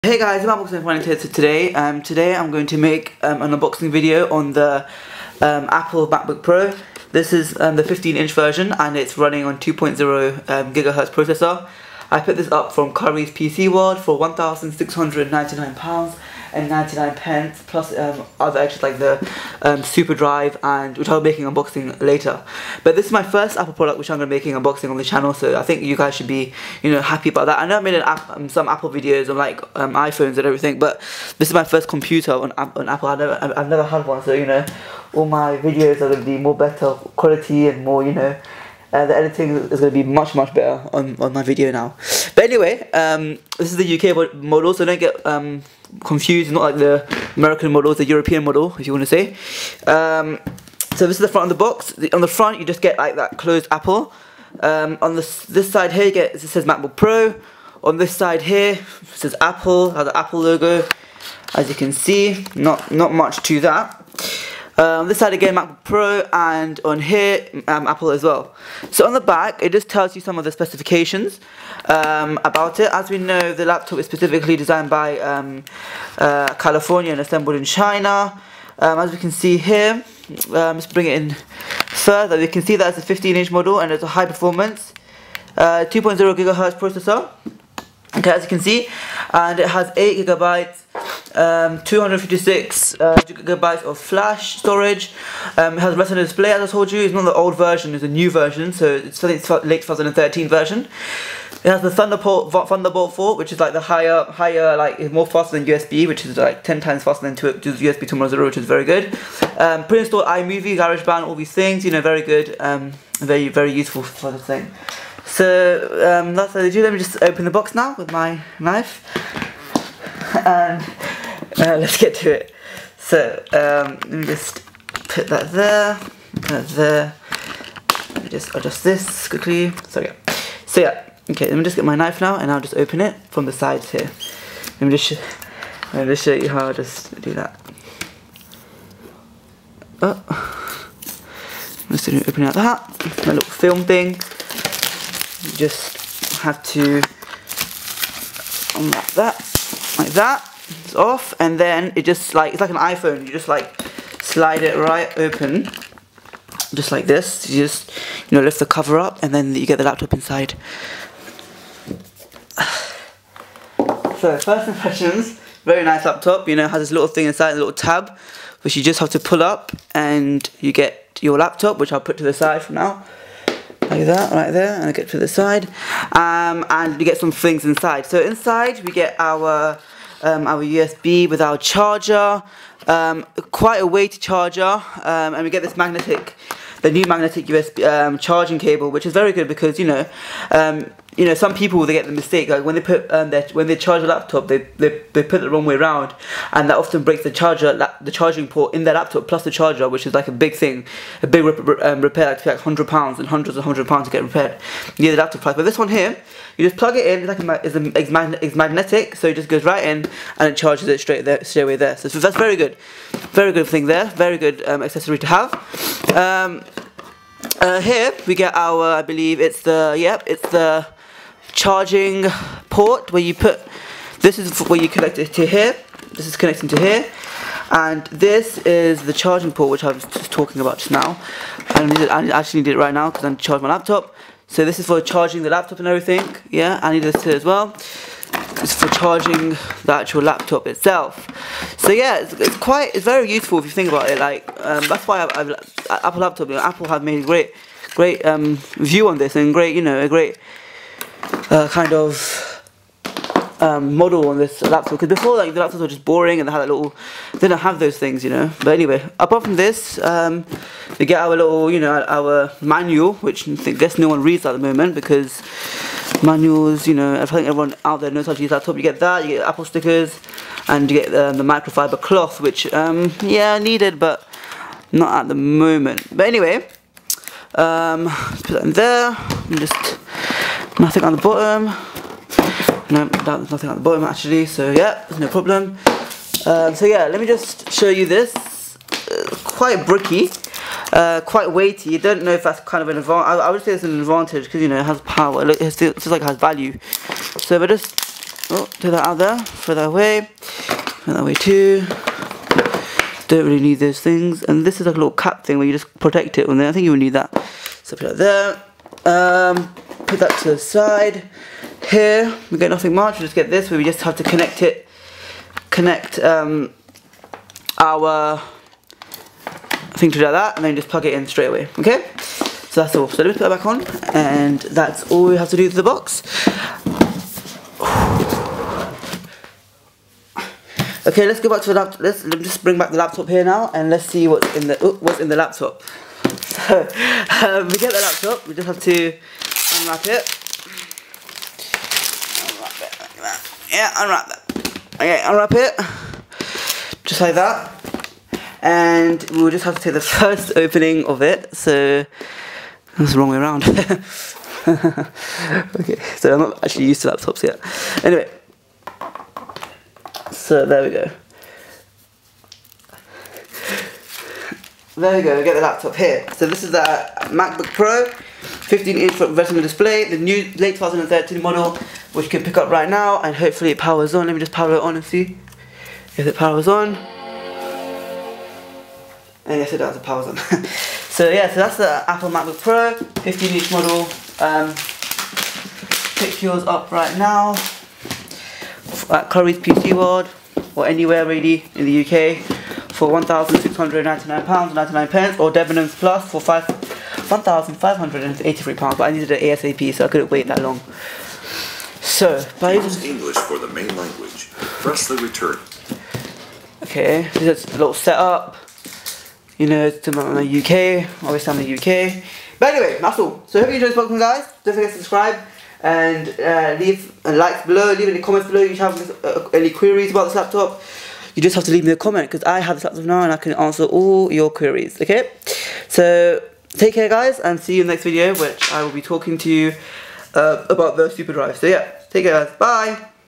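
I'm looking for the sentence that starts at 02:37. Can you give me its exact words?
You just, you know, lift the cover up and then you get the laptop inside.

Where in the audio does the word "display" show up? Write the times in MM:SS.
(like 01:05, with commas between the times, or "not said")
01:36, 06:09.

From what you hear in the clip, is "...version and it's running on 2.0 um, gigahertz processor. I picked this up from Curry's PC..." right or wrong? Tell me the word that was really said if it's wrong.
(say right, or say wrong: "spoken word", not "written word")
right.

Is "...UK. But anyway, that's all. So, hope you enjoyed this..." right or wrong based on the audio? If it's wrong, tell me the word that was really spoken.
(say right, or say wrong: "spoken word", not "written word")
right.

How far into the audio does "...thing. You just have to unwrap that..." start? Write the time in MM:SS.
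02:23.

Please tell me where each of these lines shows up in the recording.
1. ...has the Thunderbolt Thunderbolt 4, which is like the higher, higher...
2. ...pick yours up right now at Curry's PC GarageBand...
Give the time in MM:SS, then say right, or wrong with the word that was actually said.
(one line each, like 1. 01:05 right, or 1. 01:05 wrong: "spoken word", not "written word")
1. 01:41 right
2. 06:26 wrong: "World", not "GarageBand".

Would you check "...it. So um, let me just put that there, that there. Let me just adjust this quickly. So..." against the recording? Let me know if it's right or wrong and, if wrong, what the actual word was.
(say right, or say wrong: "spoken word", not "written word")
right.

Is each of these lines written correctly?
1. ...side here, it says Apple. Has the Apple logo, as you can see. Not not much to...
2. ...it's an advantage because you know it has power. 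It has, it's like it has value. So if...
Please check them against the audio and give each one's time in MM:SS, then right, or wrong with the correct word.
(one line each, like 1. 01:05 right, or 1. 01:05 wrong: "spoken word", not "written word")
1. 00:58 right
2. 04:53 right.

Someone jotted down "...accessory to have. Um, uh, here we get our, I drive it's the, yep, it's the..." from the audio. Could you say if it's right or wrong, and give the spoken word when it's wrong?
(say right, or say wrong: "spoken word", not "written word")
wrong: "believe", not "drive".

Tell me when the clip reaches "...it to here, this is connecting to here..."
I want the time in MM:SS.
03:45.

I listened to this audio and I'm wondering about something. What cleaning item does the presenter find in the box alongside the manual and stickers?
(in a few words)
microfiber cloth.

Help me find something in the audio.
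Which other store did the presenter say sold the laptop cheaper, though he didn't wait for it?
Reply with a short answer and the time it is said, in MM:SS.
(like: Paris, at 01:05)
Debenhams Plus, at 06:35.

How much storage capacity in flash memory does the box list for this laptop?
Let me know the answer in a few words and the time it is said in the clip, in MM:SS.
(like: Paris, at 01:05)
256 gigabytes, at 01:31.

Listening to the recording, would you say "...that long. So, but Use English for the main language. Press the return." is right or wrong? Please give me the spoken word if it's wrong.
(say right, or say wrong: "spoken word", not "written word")
right.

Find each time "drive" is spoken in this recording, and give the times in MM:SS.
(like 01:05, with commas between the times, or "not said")
00:20, 07:11.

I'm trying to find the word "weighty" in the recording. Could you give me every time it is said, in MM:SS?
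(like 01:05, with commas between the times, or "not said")
03:03, 04:51.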